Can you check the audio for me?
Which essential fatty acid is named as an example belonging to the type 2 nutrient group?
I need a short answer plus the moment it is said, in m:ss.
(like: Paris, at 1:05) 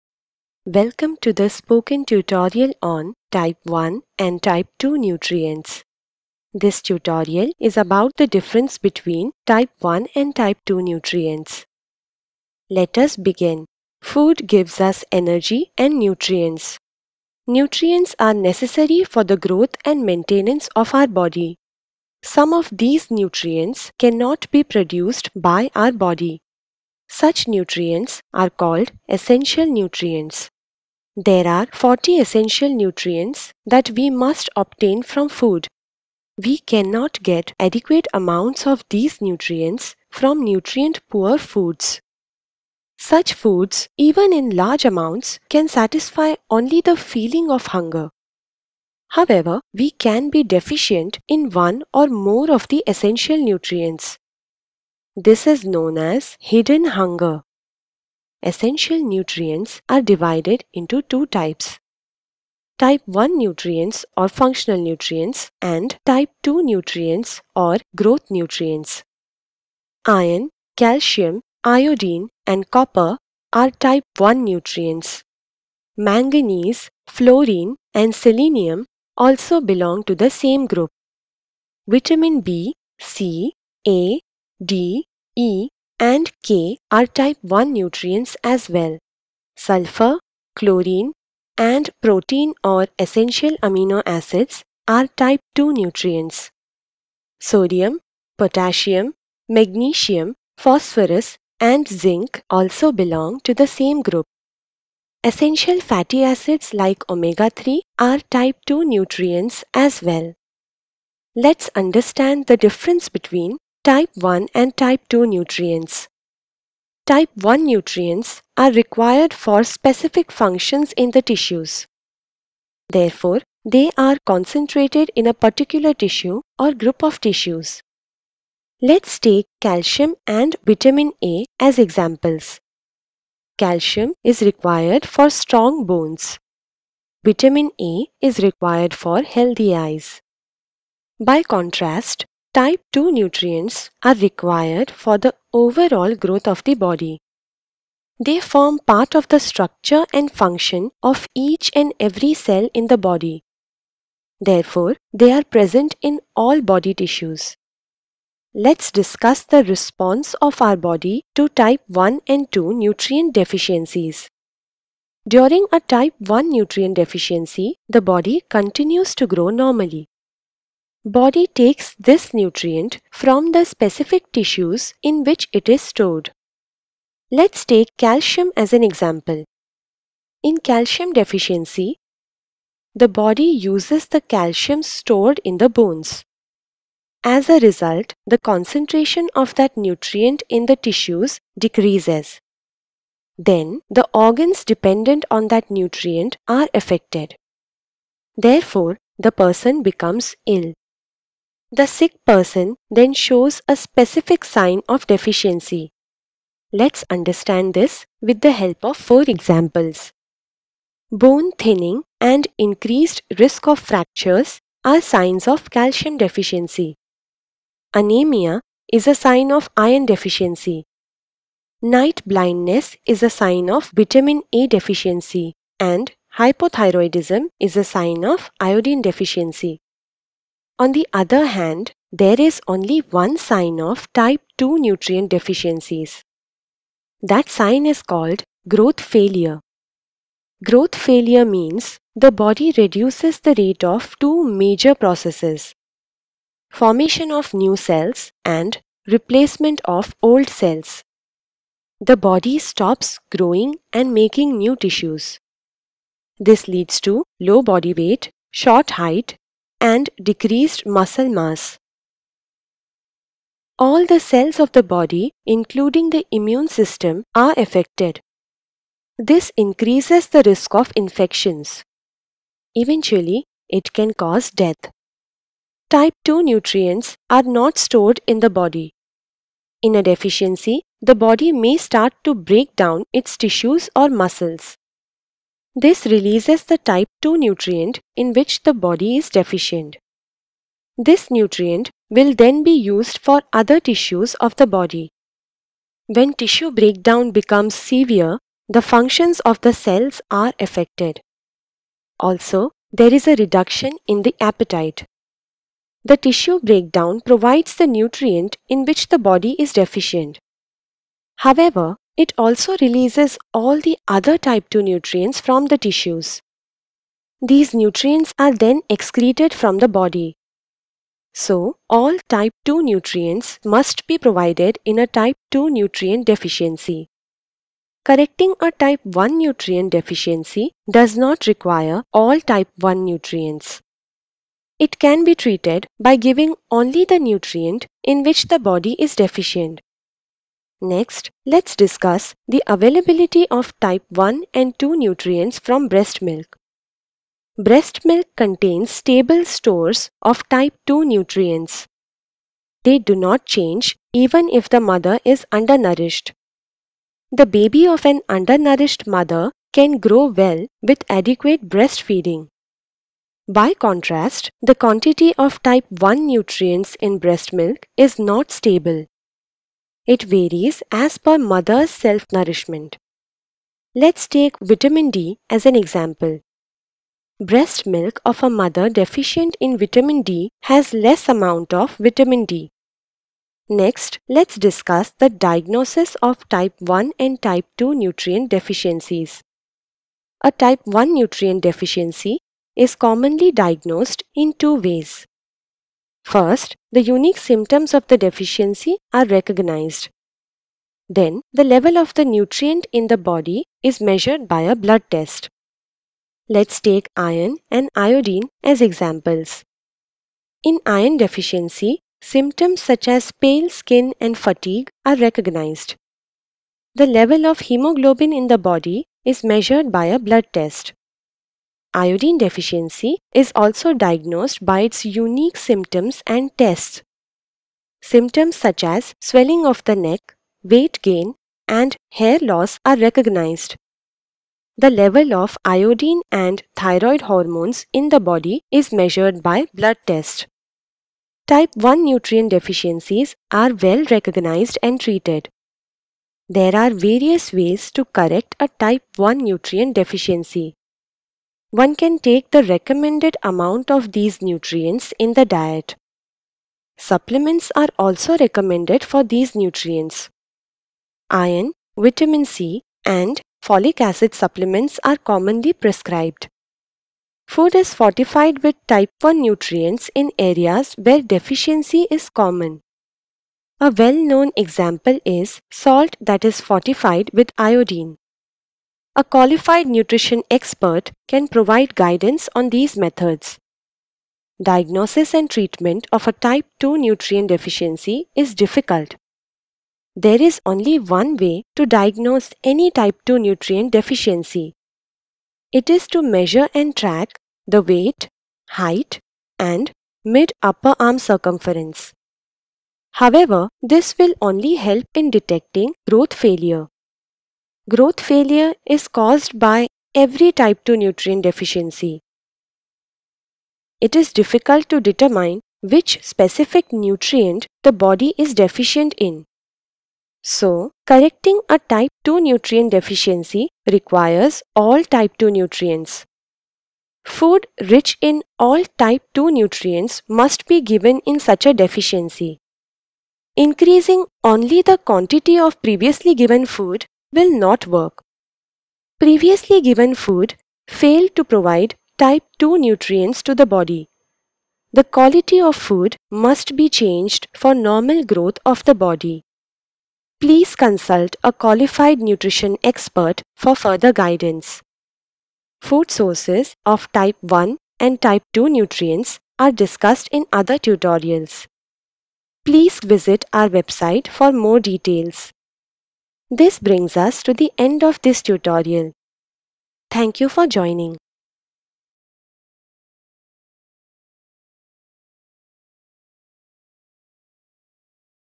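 omega-3, at 1:47.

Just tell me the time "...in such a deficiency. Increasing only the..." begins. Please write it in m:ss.
8:51.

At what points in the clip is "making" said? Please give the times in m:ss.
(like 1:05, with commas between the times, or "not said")
4:14.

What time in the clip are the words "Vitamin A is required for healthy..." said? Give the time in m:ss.
2:17.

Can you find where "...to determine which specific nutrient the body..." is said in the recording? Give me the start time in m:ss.
8:34.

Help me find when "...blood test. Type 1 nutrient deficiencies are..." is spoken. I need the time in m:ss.
7:19.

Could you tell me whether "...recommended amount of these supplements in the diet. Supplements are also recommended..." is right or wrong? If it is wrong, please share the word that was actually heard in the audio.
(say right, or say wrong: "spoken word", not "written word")
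wrong: "nutrients", not "supplements".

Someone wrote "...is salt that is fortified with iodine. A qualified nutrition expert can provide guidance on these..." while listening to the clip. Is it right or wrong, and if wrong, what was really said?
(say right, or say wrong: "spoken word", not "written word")
right.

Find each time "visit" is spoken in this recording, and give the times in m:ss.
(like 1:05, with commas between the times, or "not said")
9:22.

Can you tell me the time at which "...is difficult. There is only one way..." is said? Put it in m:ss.
8:08.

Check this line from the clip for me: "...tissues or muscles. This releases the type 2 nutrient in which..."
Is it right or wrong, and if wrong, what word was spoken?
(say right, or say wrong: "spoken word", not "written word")
right.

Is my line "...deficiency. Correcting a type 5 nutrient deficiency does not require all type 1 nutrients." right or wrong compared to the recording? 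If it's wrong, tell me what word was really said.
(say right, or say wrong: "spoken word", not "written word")
wrong: "1", not "5".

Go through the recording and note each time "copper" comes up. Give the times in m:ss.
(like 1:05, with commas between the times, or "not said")
1:12.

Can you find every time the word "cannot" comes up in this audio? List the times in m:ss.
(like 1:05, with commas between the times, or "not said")
0:23, 0:36.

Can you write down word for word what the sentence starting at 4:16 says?
This leads to low body weight, short height, and decreased muscle mass.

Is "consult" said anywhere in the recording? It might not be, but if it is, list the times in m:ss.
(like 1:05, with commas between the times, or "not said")
9:10.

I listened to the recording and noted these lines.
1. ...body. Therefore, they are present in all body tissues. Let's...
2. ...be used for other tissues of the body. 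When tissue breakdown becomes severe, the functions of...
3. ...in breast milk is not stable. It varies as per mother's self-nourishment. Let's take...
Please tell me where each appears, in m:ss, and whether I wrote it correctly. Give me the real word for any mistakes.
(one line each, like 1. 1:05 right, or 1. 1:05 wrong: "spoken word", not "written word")
1. 2:32 right
2. 4:52 right
3. 6:06 right.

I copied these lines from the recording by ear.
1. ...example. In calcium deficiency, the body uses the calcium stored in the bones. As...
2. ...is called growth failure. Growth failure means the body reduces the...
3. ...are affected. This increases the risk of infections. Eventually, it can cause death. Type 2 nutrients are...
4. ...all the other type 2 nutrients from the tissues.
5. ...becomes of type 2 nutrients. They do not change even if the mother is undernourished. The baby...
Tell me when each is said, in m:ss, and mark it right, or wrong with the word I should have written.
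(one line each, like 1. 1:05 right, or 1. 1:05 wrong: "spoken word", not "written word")
1. 2:58 right
2. 3:57 right
3. 4:27 right
4. 5:13 right
5. 5:49 wrong: "stores", not "becomes".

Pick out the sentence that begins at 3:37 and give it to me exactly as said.
Anemia is a sign of iron deficiency.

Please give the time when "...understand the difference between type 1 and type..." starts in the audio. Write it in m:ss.
1:51.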